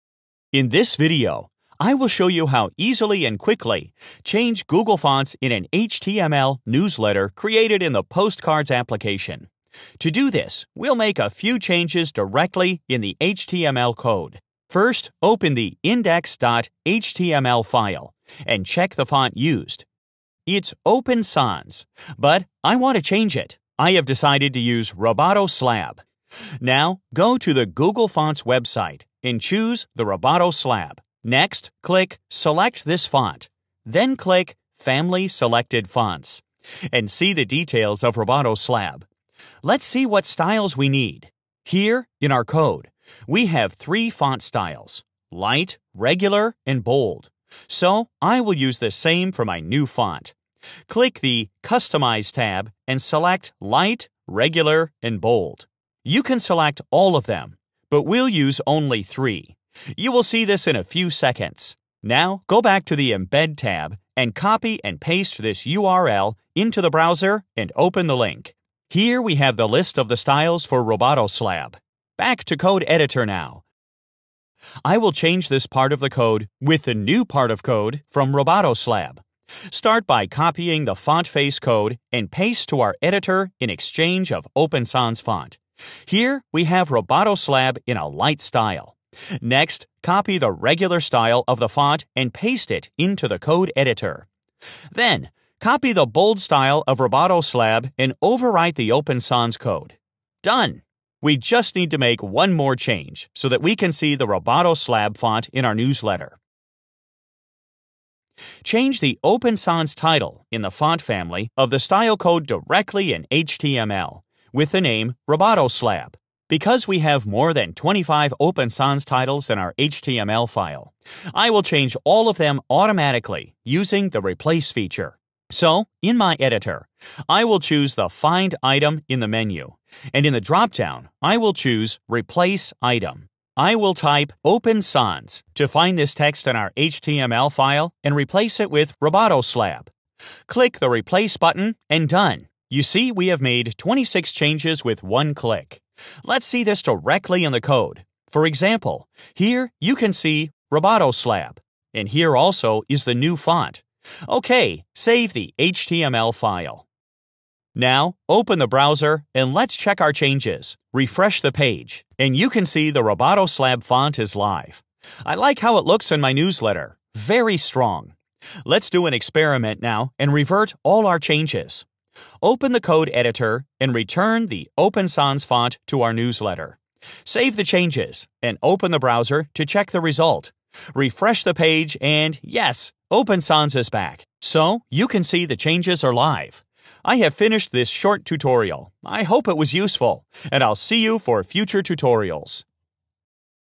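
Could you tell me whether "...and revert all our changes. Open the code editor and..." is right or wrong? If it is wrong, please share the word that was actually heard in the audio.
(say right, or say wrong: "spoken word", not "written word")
right.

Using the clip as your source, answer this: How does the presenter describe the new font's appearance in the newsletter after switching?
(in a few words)
Very strong.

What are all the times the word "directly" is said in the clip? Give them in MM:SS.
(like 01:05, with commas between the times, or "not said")
00:12, 01:52, 02:26.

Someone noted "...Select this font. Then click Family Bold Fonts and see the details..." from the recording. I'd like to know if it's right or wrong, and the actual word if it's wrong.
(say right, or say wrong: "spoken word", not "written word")
wrong: "Selected", not "Bold".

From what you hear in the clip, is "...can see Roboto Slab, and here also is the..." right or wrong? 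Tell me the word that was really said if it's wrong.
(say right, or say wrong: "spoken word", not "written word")
right.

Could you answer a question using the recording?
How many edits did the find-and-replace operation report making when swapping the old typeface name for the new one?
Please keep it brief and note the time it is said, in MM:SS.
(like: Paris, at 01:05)
26, at 02:23.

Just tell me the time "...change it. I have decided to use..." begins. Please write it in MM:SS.
00:23.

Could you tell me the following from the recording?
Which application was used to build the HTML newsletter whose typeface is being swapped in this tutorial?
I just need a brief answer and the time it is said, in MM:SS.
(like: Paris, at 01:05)
Postcards, at 00:08.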